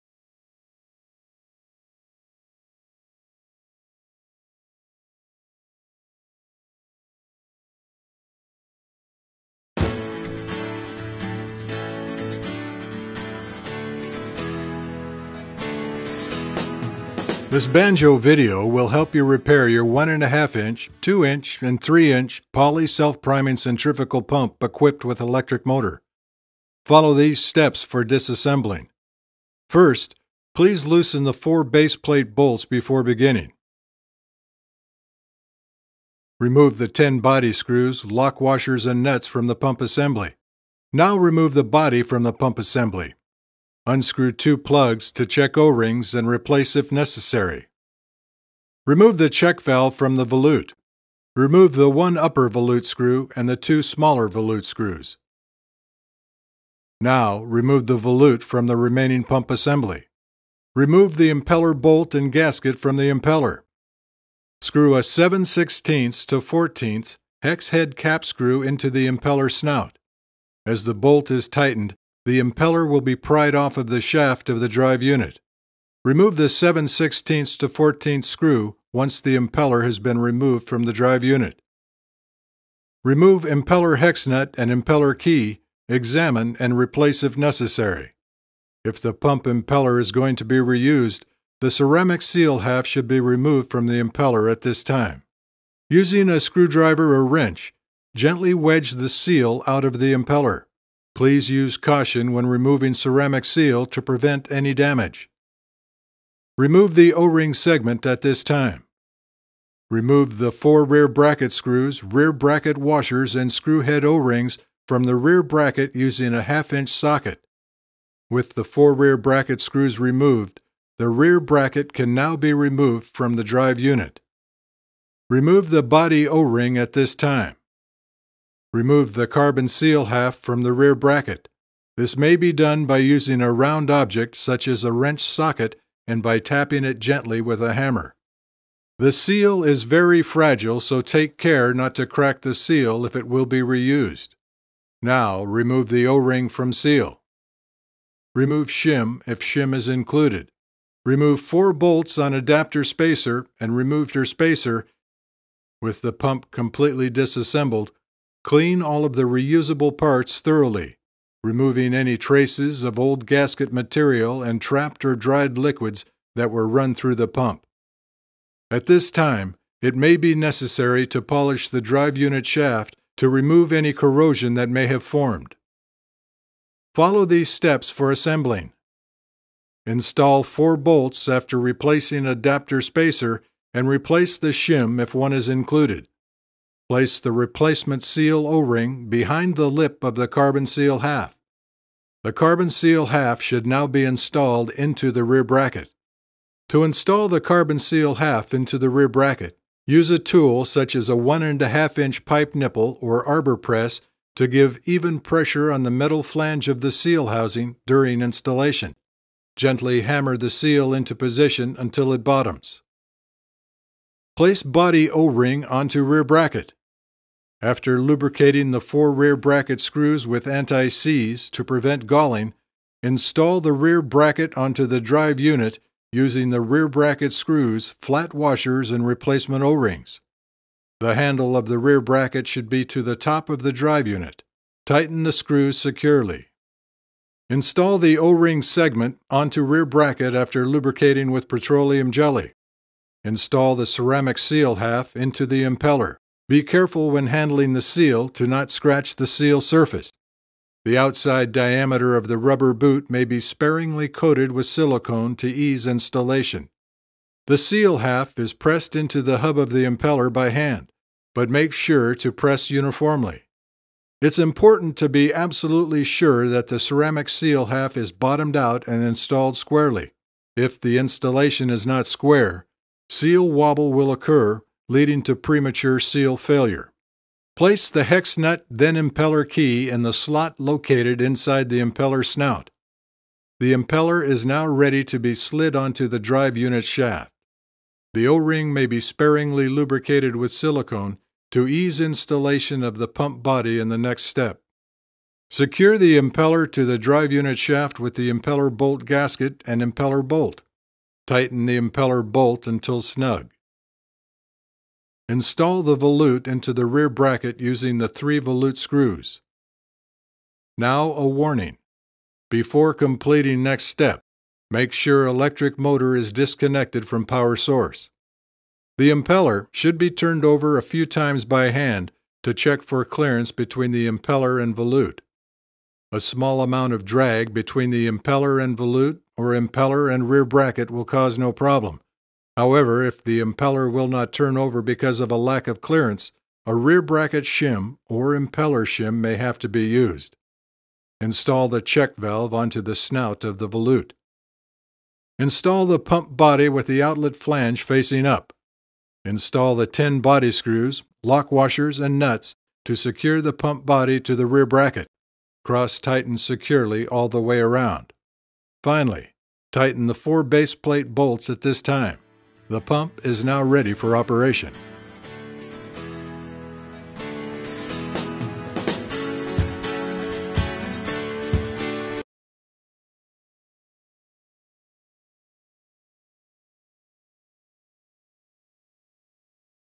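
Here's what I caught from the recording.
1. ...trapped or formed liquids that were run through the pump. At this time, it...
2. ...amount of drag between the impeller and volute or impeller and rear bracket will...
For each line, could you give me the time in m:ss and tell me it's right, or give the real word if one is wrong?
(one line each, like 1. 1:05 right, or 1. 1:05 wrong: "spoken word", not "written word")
1. 2:44 wrong: "dried", not "formed"
2. 5:26 right.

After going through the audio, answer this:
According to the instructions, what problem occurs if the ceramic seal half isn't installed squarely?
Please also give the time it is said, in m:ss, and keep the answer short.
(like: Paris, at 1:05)
seal wobble, at 4:33.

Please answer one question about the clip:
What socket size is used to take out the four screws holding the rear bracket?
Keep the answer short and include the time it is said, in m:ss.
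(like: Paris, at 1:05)
half-inch, at 1:56.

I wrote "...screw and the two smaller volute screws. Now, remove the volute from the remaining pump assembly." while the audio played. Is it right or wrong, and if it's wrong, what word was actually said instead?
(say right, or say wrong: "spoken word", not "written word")
right.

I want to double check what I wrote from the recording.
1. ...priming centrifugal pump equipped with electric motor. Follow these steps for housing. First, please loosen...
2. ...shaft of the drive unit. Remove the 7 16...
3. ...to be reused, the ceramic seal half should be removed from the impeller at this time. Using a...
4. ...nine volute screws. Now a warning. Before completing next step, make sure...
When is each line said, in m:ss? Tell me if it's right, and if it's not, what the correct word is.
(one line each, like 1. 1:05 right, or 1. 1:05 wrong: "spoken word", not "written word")
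1. 0:23 wrong: "disassembling", not "housing"
2. 1:14 right
3. 1:30 right
4. 5:08 wrong: "three", not "nine".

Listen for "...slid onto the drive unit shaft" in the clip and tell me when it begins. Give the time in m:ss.
4:45.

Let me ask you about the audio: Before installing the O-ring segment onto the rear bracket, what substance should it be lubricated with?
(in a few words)
petroleum jelly.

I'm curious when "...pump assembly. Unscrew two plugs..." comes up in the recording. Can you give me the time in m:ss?
0:42.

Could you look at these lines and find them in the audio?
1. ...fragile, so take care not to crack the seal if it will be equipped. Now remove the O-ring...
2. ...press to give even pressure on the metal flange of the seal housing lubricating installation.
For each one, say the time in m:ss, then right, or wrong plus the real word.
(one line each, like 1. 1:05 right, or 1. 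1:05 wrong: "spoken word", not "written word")
1. 2:20 wrong: "reused", not "equipped"
2. 3:23 wrong: "during", not "lubricating".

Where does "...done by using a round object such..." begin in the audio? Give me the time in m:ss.
2:12.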